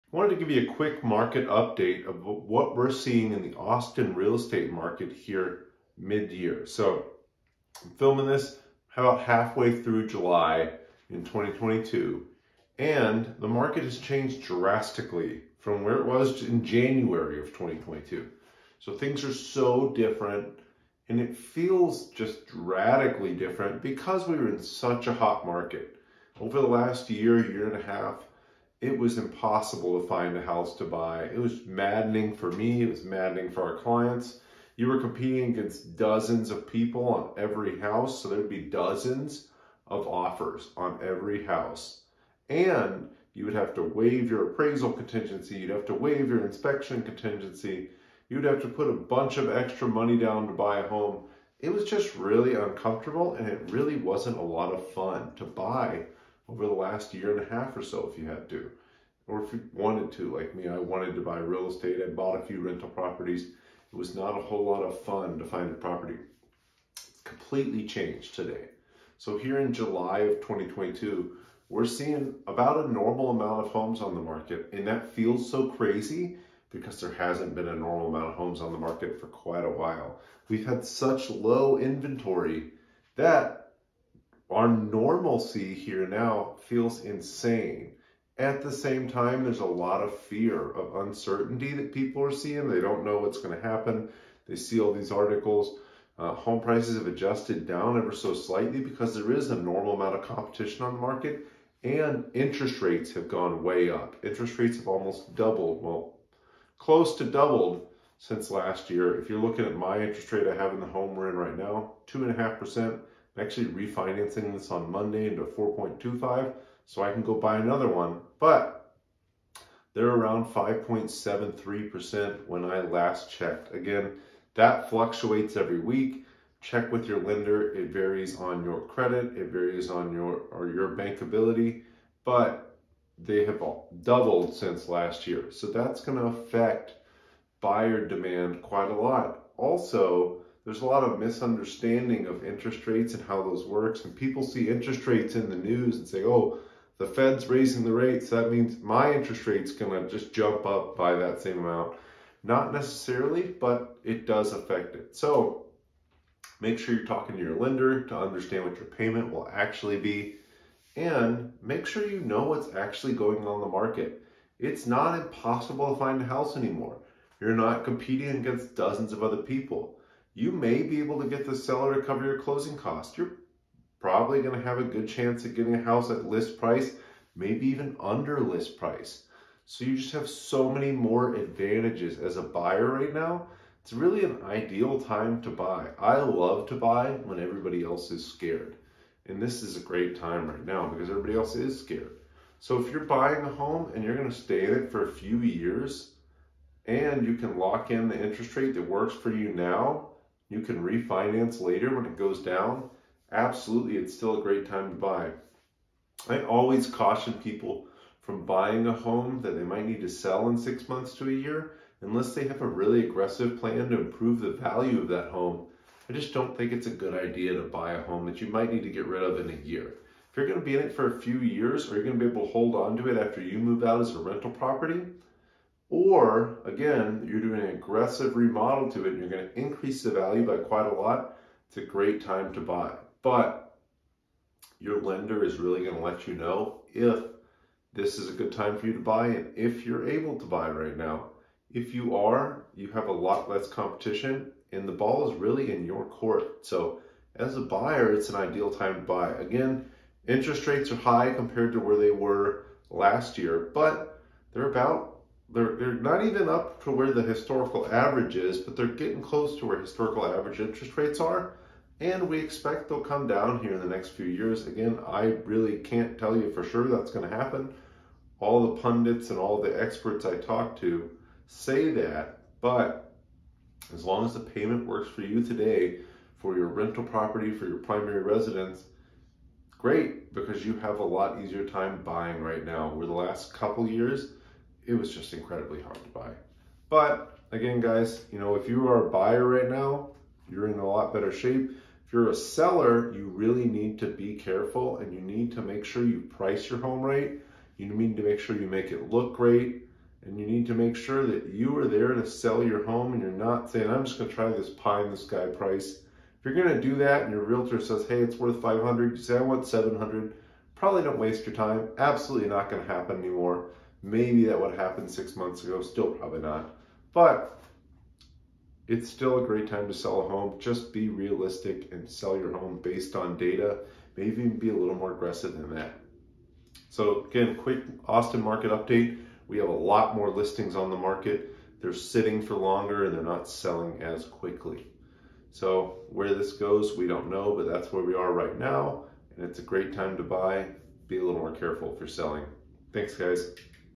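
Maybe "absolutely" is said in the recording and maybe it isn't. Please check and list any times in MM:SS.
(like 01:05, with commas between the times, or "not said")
03:23, 05:11.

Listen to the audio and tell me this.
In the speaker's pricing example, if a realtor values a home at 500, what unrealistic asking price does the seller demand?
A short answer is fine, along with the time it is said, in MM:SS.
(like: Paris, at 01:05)
700, at 05:09.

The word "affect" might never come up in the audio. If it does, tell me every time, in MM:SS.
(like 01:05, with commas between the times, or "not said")
02:16, 02:34.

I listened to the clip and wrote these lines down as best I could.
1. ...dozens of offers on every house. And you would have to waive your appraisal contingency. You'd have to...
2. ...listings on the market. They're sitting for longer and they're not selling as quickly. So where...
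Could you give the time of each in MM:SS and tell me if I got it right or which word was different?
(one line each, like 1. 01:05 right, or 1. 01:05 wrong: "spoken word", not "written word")
1. 00:38 right
2. 05:30 right.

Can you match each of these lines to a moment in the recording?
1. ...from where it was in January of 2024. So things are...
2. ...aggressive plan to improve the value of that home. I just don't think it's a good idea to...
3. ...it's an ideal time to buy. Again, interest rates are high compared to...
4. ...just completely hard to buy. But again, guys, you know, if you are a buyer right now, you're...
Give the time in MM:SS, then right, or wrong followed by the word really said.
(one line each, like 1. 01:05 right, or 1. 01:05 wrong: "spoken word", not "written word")
1. 00:15 wrong: "2022", not "2024"
2. 03:33 right
3. 04:08 right
4. 04:45 wrong: "incredibly", not "completely".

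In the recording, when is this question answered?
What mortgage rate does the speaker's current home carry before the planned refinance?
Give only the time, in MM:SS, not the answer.
01:52.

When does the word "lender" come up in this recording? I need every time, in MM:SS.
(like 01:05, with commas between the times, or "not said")
02:07, 02:37, 03:54.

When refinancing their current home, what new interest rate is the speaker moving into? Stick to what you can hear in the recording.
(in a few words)
4.25%.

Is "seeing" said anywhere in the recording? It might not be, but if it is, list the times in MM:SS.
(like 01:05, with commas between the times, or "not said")
00:02, 01:11, 01:32.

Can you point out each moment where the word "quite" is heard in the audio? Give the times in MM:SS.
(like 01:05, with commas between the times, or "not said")
01:19, 02:18, 03:50.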